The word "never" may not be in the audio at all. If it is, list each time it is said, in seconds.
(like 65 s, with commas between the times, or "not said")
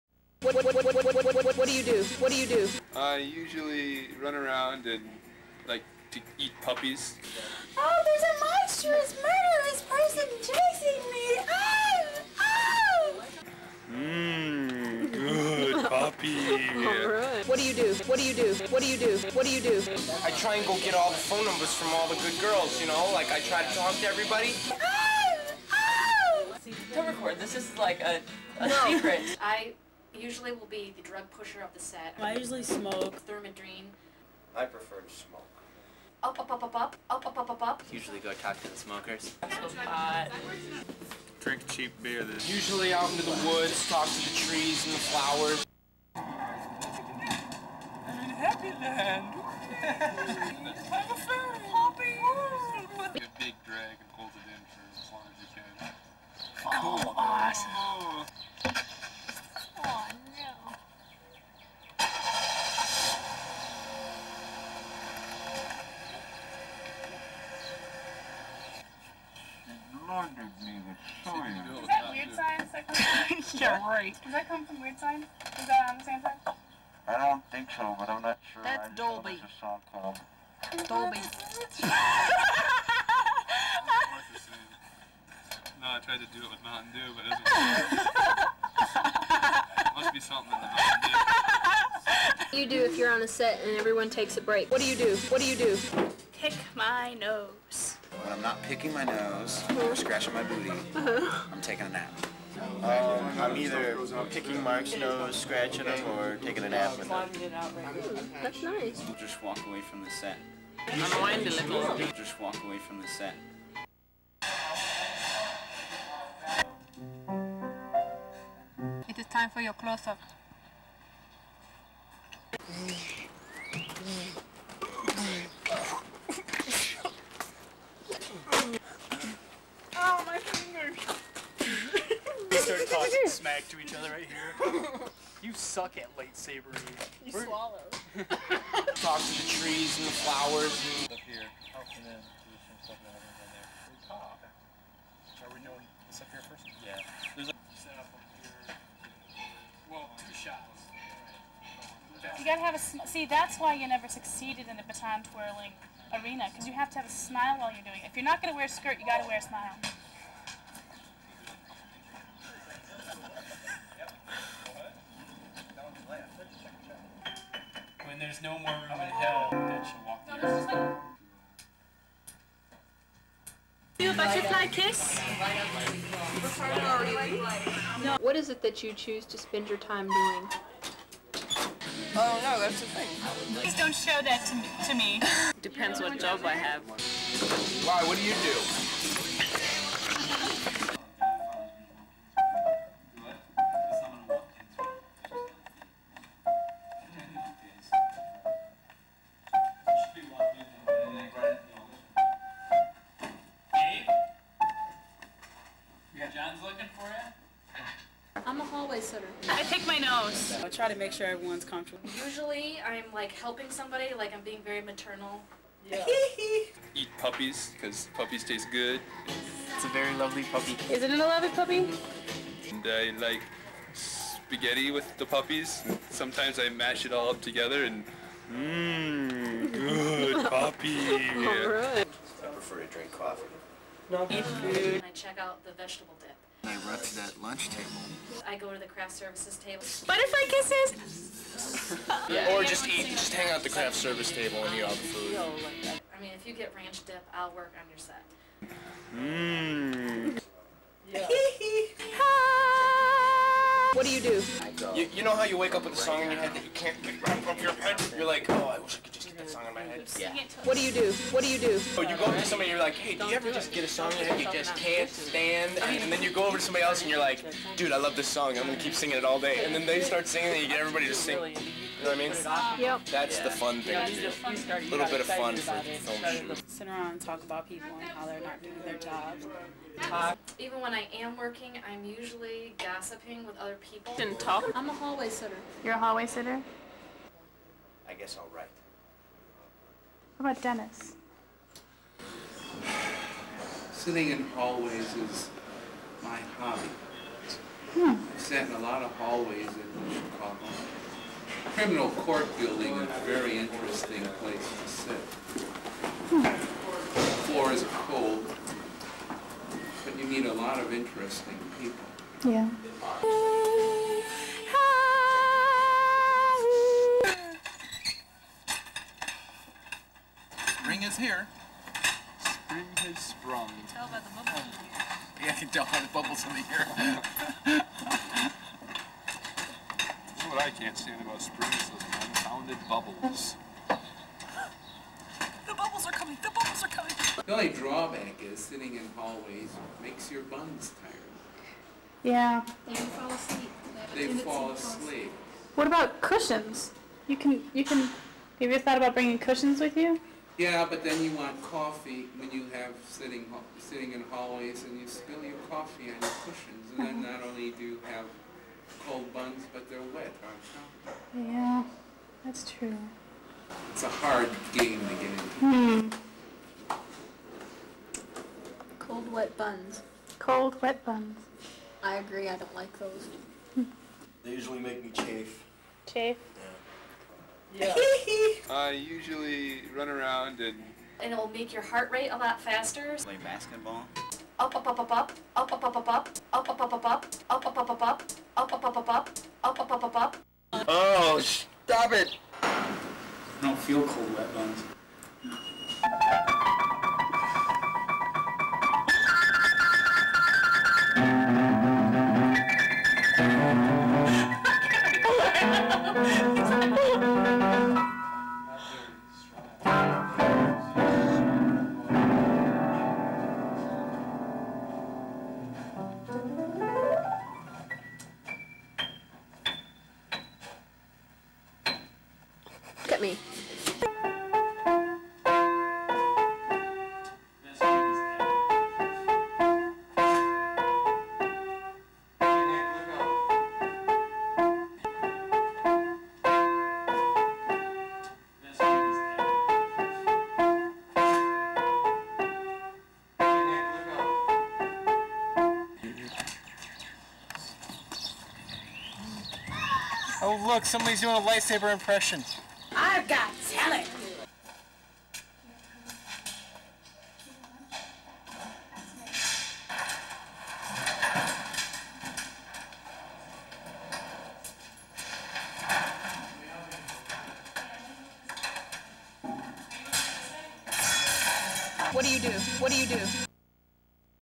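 153 s.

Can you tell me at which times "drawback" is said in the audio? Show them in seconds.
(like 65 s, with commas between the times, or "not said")
337 s.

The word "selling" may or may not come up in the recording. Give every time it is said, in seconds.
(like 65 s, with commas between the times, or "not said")
not said.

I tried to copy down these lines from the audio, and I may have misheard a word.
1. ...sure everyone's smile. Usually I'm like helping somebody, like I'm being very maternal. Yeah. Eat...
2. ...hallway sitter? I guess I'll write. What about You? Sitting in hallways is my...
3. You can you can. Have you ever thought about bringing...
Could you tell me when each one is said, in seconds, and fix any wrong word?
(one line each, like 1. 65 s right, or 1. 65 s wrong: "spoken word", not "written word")
1. 211 s wrong: "comfortable", not "smile"
2. 285 s wrong: "Dennis", not "You"
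3. 347 s right.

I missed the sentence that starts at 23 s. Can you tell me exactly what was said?
Like, I try to talk to everybody.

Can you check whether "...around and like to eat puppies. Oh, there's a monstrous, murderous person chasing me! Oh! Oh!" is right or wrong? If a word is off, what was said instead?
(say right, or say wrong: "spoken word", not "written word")
right.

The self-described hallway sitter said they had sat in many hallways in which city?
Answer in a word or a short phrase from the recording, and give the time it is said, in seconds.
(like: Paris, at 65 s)
Chicago, at 300 s.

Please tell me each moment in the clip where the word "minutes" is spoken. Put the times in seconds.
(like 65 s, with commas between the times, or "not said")
not said.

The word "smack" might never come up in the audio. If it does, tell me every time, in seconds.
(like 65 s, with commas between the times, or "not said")
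133 s.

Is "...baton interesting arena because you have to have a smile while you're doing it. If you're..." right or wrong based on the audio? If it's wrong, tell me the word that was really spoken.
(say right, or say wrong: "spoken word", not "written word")
wrong: "twirling", not "interesting".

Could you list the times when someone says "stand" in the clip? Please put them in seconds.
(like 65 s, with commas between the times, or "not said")
265 s, 330 s.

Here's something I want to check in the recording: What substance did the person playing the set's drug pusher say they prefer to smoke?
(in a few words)
Thermidrine.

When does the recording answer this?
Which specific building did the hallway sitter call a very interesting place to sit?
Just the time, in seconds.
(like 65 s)
301 s.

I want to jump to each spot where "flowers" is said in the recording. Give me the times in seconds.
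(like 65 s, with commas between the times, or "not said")
44 s, 140 s.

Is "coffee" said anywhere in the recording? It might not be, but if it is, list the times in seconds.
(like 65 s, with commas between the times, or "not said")
233 s, 351 s, 355 s.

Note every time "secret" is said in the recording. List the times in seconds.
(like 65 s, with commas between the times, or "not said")
28 s.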